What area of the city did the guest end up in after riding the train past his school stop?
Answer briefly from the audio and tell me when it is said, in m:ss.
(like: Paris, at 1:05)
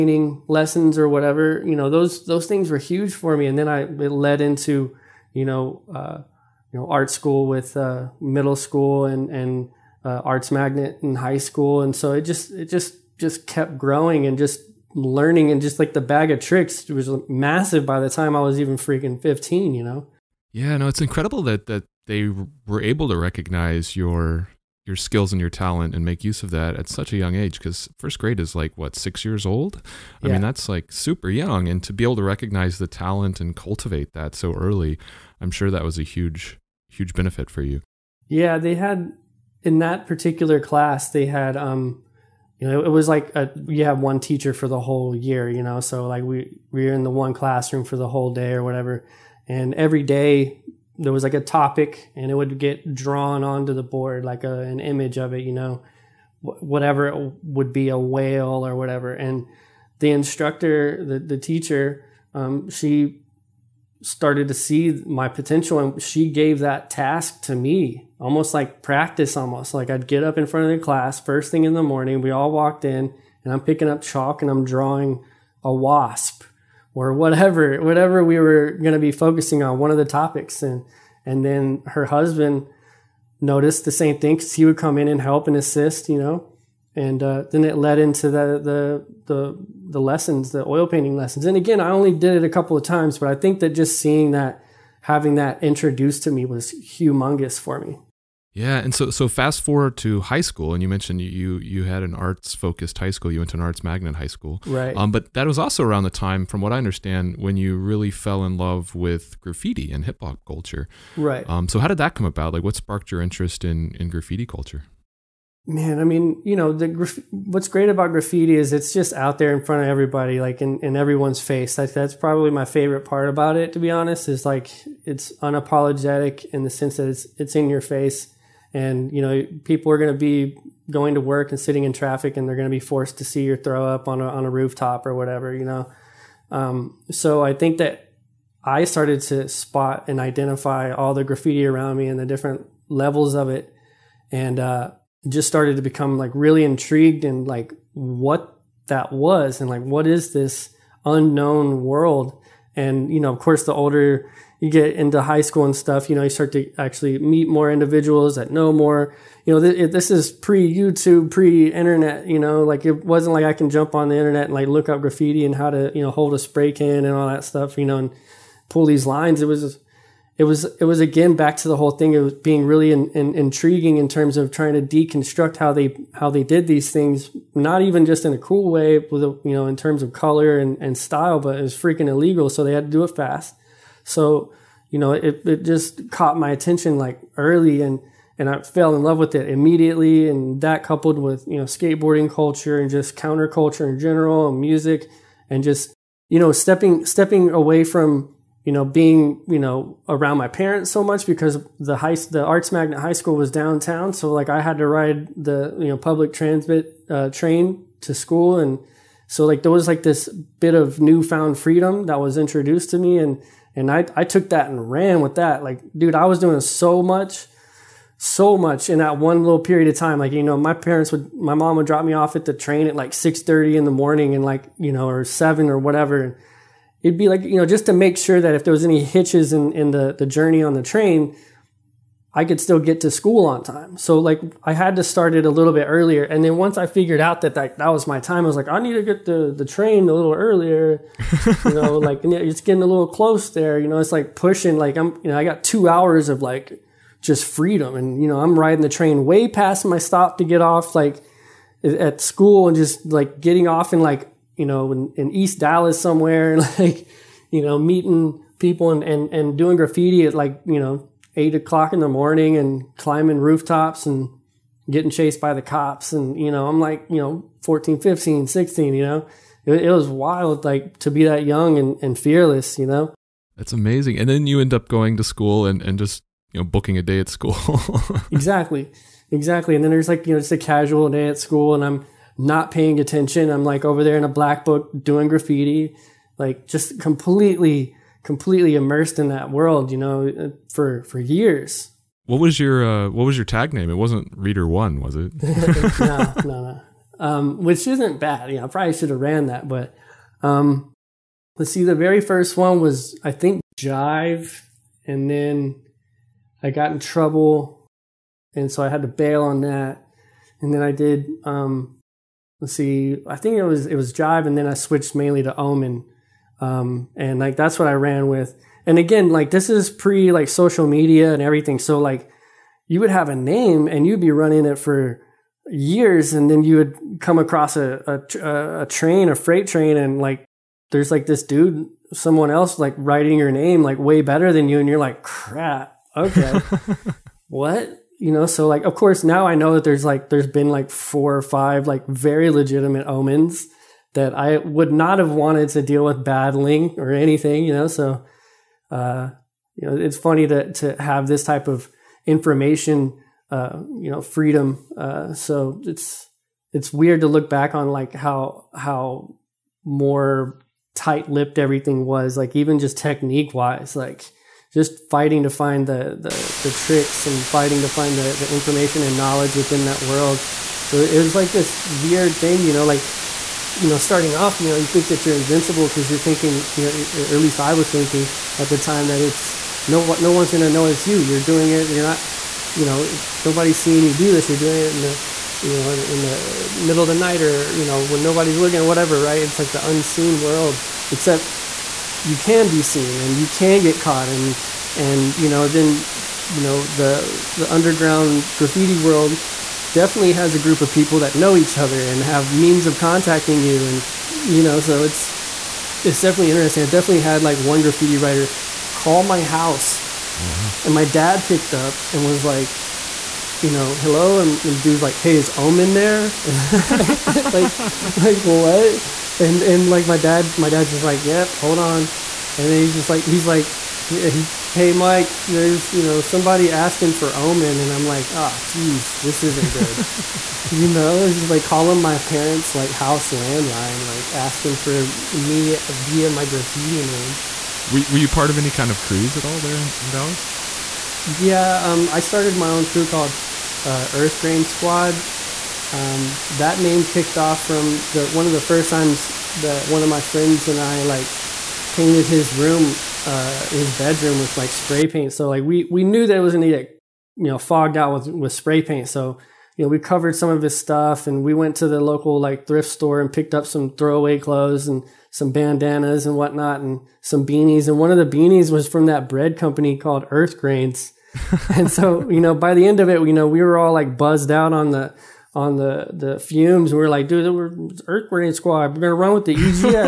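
East Dallas, at 4:15.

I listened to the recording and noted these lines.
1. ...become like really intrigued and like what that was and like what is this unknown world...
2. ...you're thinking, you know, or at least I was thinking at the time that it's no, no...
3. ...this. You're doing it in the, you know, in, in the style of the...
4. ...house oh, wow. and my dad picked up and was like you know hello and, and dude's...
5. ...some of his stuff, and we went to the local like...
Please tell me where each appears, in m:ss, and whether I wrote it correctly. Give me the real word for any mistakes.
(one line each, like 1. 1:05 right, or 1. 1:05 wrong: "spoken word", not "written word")
1. 2:25 right
2. 6:16 right
3. 6:24 wrong: "middle", not "style"
4. 6:49 right
5. 7:40 right.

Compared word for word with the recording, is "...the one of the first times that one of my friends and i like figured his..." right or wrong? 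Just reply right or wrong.
wrong.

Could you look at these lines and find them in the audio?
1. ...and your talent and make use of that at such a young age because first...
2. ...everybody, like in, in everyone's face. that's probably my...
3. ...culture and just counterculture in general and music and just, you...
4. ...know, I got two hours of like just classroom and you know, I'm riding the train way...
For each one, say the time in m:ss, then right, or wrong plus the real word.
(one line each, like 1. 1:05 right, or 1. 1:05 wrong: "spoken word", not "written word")
1. 0:25 right
2. 1:59 right
3. 3:12 right
4. 4:05 wrong: "freedom", not "classroom".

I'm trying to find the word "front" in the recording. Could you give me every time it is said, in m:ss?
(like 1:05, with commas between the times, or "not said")
1:10, 1:59.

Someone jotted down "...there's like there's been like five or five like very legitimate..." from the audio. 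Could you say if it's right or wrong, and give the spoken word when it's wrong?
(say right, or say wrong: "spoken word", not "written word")
wrong: "four", not "five".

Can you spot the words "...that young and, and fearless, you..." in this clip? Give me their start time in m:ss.
4:31.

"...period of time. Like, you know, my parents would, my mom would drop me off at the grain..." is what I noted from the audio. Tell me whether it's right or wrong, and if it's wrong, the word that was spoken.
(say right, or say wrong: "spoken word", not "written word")
wrong: "train", not "grain".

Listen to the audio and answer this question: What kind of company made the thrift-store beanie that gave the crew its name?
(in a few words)
Bread company.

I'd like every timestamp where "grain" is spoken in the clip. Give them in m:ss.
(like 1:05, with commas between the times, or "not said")
7:24, 7:50, 7:58.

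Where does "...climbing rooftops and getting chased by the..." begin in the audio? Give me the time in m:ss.
4:22.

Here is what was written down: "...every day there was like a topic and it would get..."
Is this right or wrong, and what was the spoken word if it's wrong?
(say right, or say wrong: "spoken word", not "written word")
right.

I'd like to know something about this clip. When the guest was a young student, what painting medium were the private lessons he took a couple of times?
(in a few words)
Oil painting.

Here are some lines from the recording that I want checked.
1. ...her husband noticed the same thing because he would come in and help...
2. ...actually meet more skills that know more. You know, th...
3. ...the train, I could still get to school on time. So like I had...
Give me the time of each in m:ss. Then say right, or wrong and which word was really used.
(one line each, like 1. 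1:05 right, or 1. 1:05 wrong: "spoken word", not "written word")
1. 1:21 right
2. 2:36 wrong: "individuals", not "skills"
3. 3:50 right.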